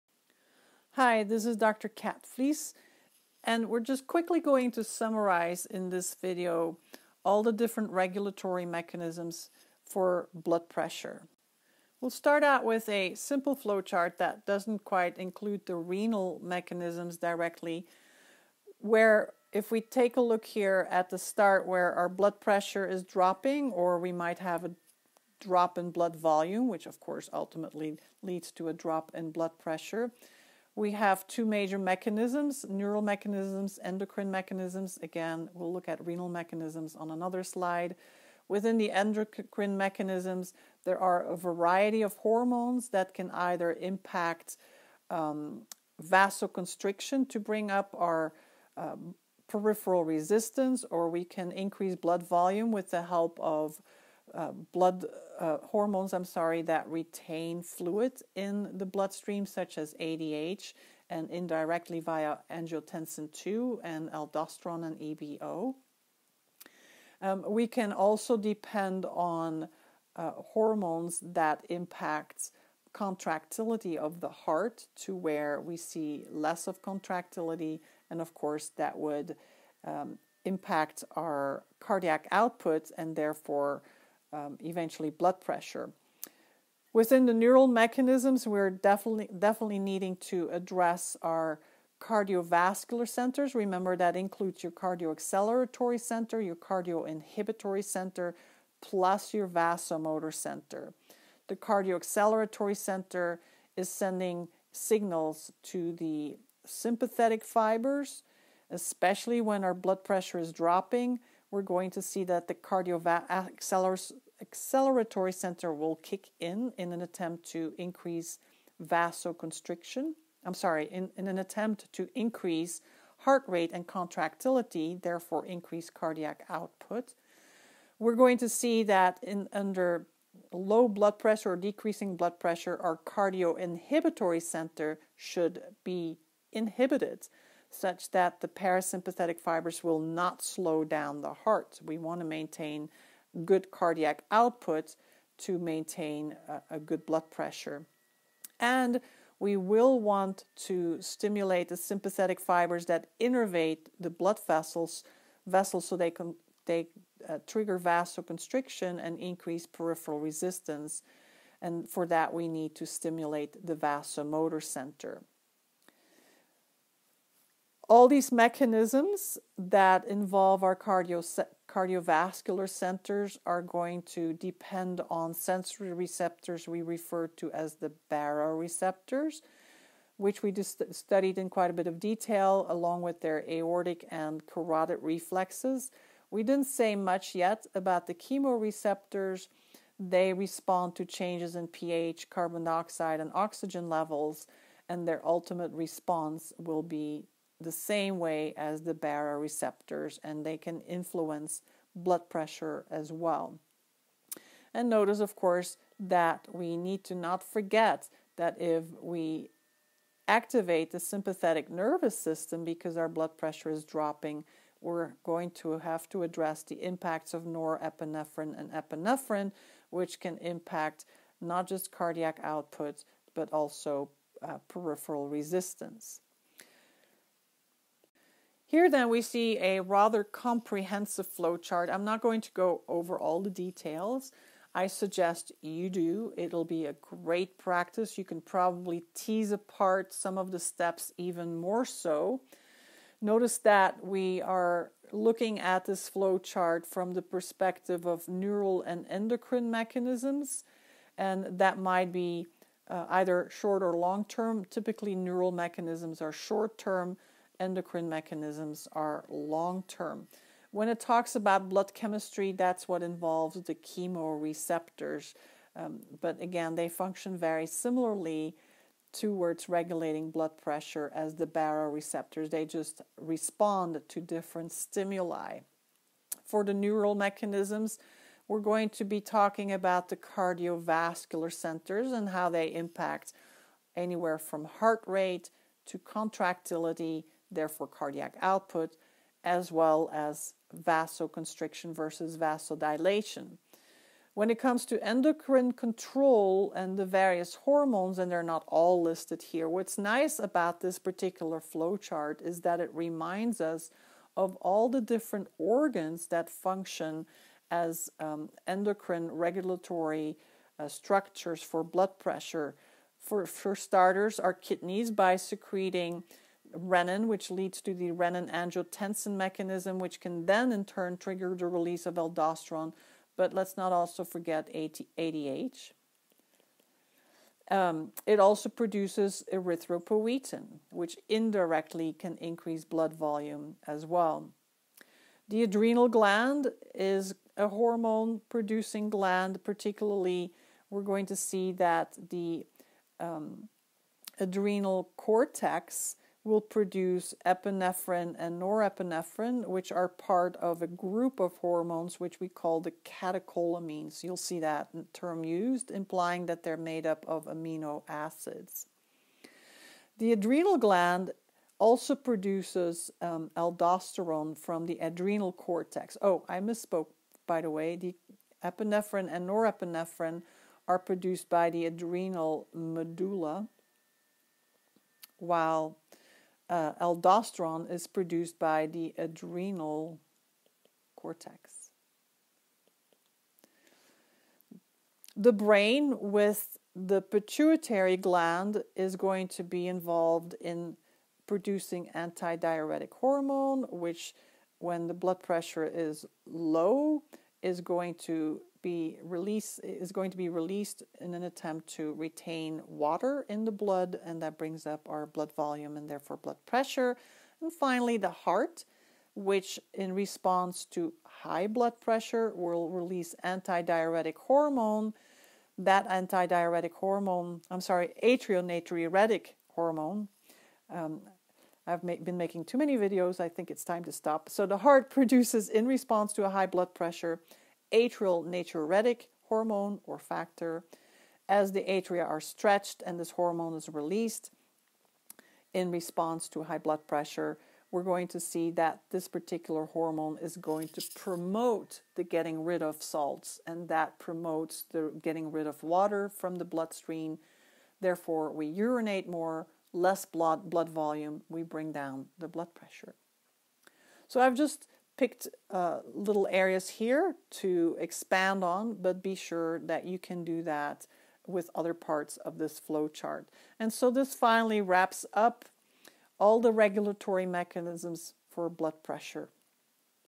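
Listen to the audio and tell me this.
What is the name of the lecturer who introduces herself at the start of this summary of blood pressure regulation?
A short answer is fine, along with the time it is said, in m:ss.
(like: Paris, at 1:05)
Dr. Kat Flies, at 0:01.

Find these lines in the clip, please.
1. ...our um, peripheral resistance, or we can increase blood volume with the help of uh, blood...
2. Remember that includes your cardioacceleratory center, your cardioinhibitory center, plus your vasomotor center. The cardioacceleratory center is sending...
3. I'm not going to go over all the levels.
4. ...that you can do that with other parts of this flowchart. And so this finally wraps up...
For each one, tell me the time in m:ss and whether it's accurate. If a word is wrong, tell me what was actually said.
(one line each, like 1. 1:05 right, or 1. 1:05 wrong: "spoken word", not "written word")
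1. 0:47 right
2. 1:33 right
3. 3:51 wrong: "details", not "levels"
4. 7:39 right.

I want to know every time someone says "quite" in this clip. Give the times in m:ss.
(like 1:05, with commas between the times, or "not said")
0:14, 3:01.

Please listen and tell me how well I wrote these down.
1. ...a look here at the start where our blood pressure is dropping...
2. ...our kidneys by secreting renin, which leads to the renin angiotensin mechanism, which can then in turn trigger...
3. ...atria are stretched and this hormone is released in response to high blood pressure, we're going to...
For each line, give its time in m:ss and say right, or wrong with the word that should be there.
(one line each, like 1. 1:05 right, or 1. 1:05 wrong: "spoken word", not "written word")
1. 0:20 right
2. 5:14 right
3. 7:11 right.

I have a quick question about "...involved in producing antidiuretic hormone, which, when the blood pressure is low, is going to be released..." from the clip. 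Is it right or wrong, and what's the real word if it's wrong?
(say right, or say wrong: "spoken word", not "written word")
right.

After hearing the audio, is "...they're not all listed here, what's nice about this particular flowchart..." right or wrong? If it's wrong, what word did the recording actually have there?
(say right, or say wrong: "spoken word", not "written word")
right.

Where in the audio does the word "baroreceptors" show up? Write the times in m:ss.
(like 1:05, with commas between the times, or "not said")
2:58, 3:18, 4:31.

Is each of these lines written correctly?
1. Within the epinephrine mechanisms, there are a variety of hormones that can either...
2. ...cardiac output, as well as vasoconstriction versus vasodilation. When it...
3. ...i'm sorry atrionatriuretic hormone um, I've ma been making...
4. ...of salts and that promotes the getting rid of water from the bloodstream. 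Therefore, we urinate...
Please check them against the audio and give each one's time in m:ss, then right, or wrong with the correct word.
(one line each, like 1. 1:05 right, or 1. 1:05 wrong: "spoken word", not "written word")
1. 0:38 wrong: "endocrine", not "epinephrine"
2. 4:47 right
3. 6:57 right
4. 7:22 right.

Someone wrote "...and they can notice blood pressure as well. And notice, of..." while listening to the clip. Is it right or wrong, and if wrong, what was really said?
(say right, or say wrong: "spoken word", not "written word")
wrong: "influence", not "notice".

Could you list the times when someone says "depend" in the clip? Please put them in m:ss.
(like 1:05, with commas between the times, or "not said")
1:08, 2:54.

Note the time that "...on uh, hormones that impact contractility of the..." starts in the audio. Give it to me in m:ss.
1:09.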